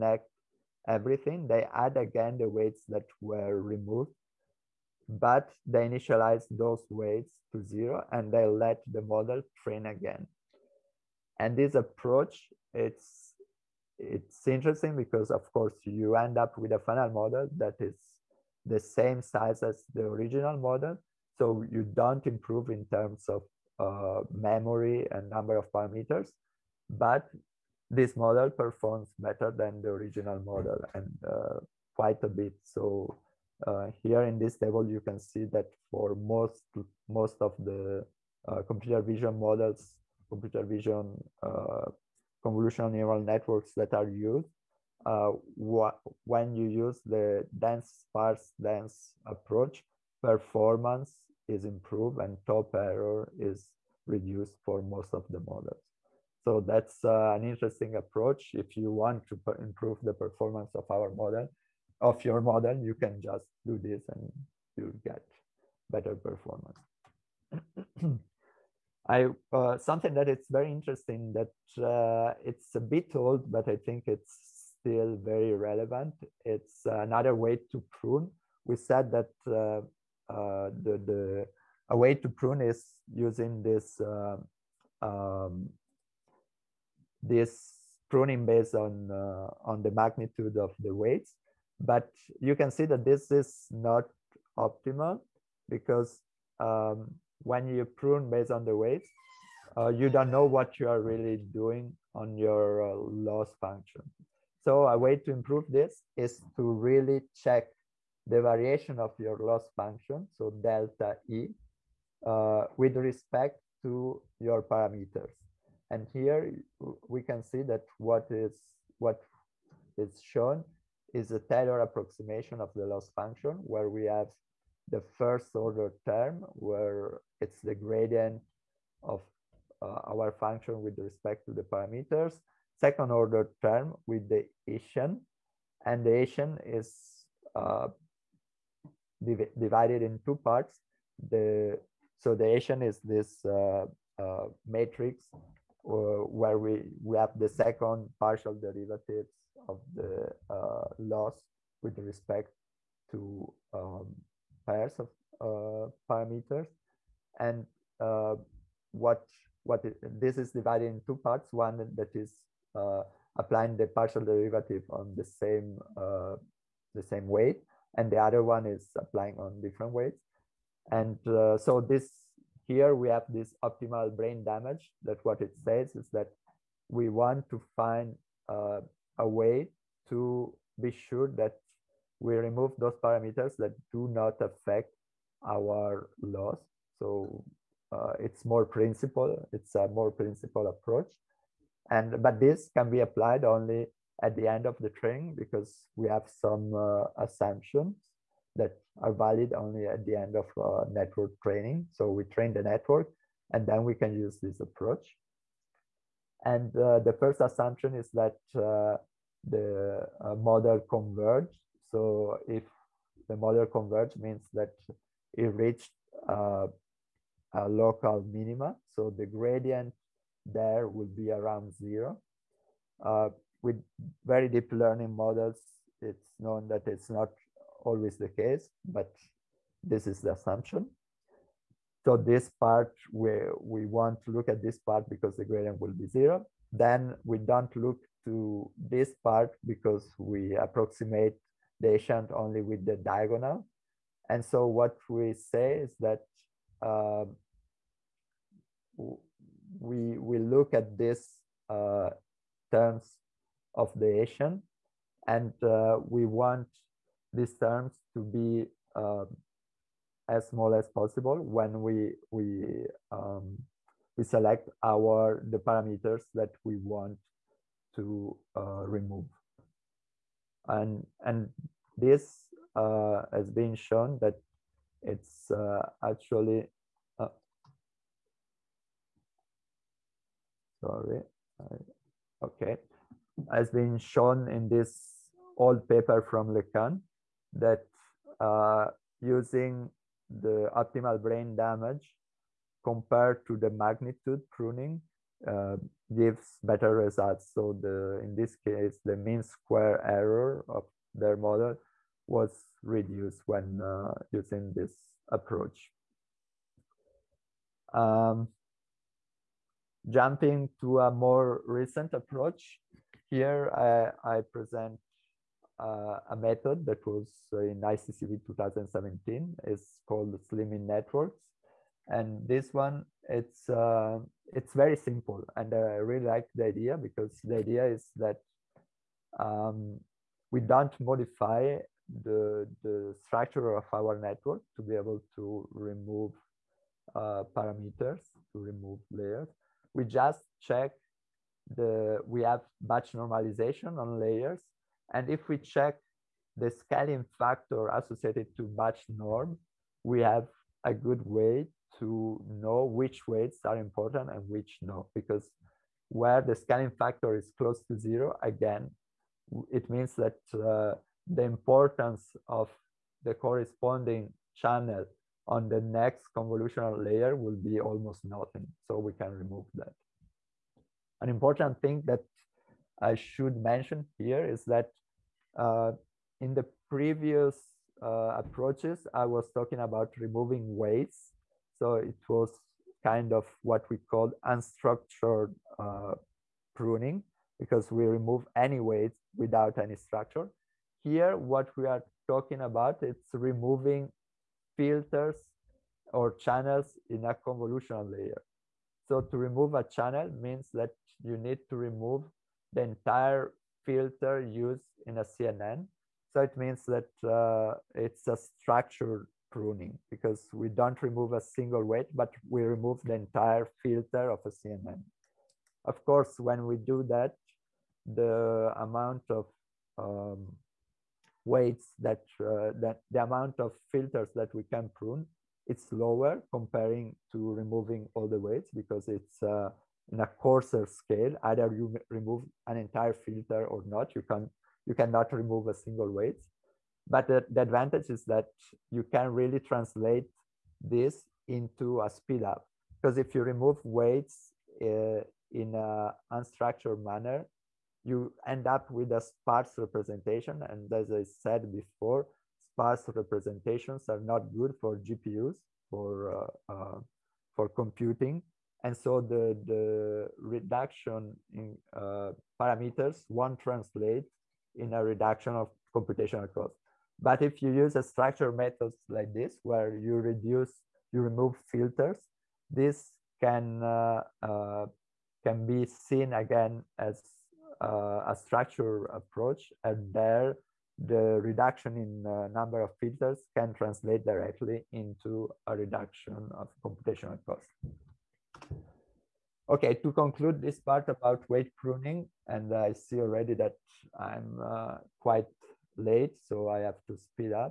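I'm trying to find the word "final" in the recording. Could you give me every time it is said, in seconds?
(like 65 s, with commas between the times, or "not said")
16 s.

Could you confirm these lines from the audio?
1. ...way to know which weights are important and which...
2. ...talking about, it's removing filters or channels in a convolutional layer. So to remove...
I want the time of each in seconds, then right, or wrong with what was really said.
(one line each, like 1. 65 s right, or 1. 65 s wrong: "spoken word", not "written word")
1. 351 s right
2. 392 s right.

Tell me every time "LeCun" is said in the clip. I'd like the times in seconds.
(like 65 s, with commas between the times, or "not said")
286 s.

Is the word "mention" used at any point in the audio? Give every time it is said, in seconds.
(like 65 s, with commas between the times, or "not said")
373 s.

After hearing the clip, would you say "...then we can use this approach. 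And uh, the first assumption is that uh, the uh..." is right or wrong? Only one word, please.
right.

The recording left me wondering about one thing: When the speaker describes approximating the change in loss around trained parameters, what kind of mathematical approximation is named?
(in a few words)
Taylor approximation.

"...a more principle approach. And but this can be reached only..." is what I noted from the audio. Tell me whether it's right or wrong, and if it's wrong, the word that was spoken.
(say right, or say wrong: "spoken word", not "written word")
wrong: "applied", not "reached".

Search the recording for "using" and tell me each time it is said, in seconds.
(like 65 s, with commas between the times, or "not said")
83 s, 289 s, 304 s.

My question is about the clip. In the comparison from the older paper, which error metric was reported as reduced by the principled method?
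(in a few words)
Mean square error.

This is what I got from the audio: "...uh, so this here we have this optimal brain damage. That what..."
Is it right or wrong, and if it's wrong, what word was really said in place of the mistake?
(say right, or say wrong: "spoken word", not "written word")
right.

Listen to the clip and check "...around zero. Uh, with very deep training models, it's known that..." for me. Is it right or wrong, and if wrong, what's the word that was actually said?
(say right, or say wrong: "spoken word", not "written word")
wrong: "learning", not "training".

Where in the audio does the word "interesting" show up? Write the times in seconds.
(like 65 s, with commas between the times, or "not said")
14 s, 57 s, 70 s.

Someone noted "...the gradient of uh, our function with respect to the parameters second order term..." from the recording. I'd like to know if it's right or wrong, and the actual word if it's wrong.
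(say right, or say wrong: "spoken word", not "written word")
right.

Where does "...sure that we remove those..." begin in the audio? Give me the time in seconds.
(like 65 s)
181 s.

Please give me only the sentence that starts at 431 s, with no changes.
Either you remove an entire filter or not.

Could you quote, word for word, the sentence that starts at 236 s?
Then we don't look to this part because we approximate the Hessian only with the diagonal.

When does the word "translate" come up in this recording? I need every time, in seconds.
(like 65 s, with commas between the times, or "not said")
439 s, 463 s, 483 s.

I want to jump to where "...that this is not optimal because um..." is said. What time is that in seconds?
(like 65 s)
92 s.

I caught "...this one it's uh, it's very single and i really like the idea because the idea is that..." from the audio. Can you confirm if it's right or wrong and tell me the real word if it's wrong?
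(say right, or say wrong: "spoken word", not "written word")
wrong: "simple", not "single".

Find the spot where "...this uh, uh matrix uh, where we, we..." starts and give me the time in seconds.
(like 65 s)
143 s.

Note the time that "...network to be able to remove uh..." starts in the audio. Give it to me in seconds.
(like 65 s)
334 s.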